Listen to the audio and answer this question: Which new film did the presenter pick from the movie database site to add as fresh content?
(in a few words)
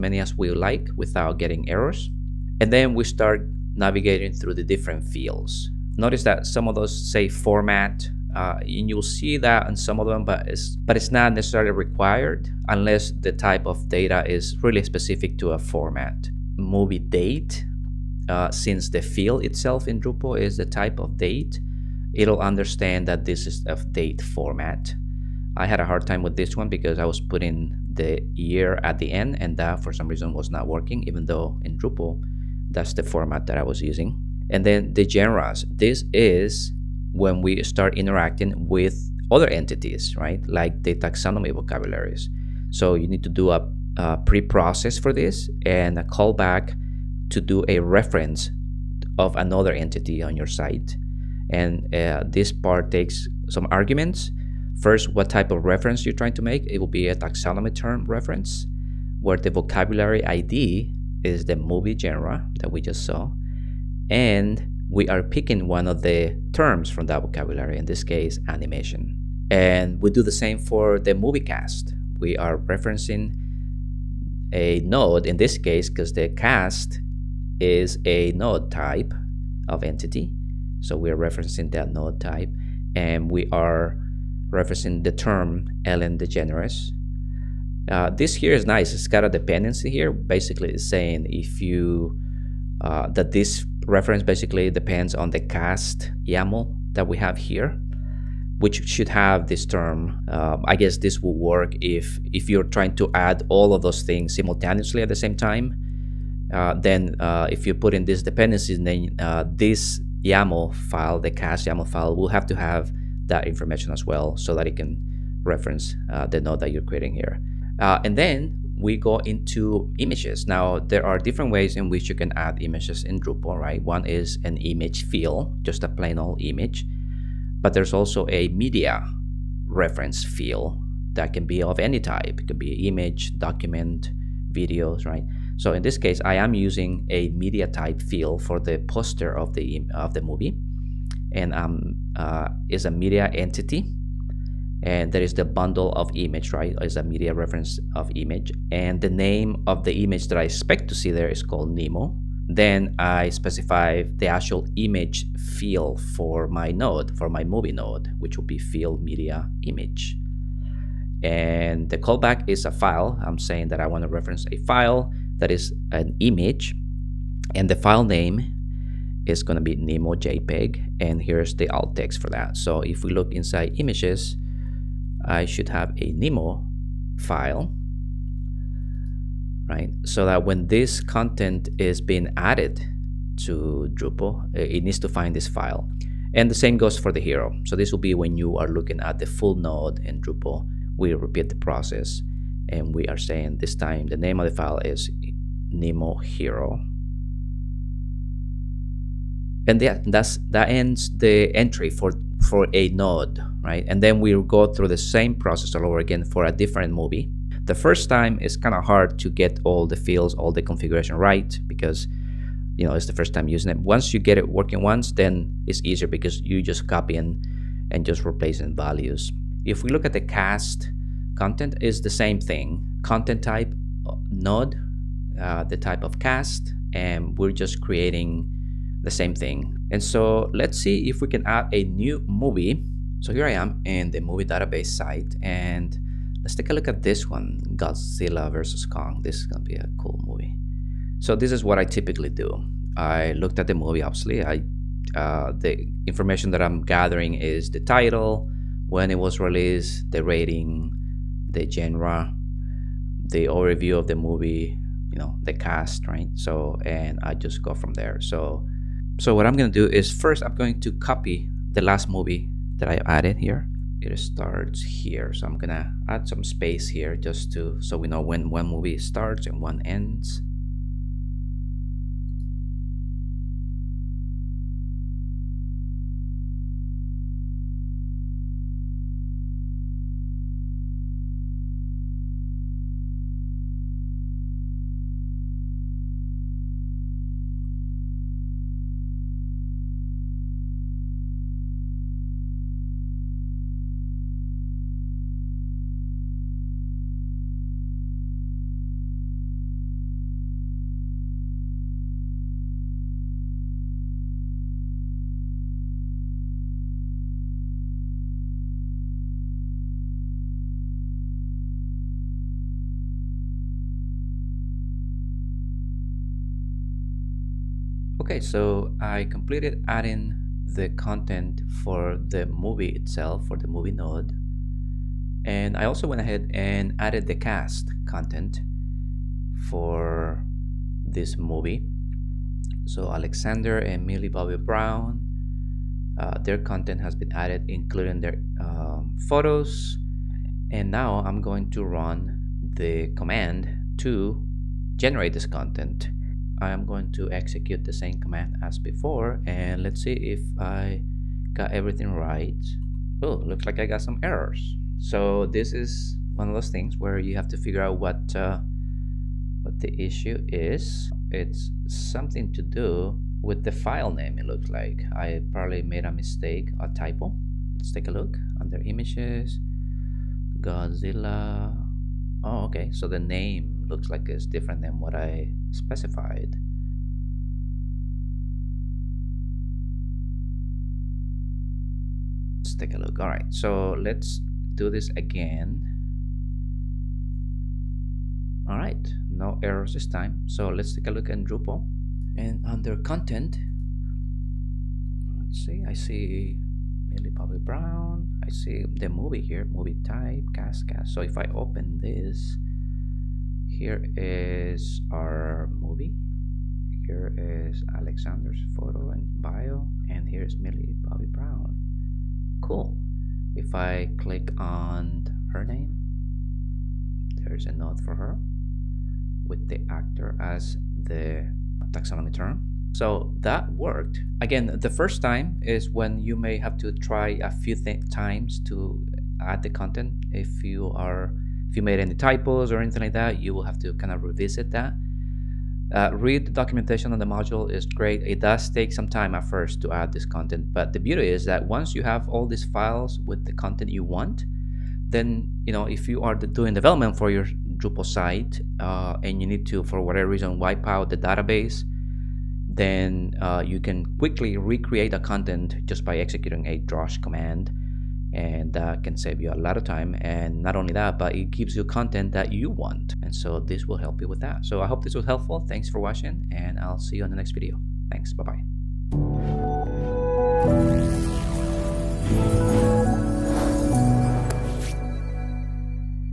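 Godzilla versus Kong.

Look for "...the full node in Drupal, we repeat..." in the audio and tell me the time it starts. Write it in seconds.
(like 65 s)
189 s.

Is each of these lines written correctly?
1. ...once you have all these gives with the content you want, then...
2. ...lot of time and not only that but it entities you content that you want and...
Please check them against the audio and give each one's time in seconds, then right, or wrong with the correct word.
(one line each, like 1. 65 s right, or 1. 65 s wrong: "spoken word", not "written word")
1. 441 s wrong: "files", not "gives"
2. 459 s wrong: "gives", not "entities".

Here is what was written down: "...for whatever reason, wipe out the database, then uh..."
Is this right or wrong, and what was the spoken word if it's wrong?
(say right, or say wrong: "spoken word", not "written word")
right.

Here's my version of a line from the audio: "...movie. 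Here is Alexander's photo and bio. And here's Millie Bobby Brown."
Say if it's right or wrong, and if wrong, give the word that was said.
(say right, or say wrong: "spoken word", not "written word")
right.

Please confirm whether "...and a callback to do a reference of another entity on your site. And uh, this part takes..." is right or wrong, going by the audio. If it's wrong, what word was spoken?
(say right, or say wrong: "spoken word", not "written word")
right.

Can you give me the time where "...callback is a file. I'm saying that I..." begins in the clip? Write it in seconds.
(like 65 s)
161 s.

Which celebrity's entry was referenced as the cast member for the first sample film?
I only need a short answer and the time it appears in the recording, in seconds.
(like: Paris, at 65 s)
Ellen DeGeneres, at 85 s.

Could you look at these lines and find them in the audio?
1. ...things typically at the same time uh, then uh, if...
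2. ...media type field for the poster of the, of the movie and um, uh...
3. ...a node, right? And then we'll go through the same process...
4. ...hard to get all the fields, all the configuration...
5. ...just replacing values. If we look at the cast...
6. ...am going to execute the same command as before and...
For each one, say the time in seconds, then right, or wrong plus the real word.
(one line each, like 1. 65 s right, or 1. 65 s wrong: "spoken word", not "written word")
1. 104 s wrong: "simultaneously", not "typically"
2. 137 s right
3. 202 s right
4. 208 s right
5. 218 s right
6. 346 s right.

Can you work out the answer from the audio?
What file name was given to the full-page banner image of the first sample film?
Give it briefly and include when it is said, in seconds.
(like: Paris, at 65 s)
Nemo Hero, at 195 s.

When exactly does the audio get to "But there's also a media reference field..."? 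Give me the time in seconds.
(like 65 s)
127 s.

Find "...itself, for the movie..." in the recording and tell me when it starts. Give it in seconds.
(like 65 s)
322 s.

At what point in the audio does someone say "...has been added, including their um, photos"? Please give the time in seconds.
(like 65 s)
337 s.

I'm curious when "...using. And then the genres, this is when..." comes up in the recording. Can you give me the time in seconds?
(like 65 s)
33 s.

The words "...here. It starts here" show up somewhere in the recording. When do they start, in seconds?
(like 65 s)
263 s.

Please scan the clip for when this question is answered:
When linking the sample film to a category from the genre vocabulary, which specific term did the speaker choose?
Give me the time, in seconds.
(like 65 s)
68 s.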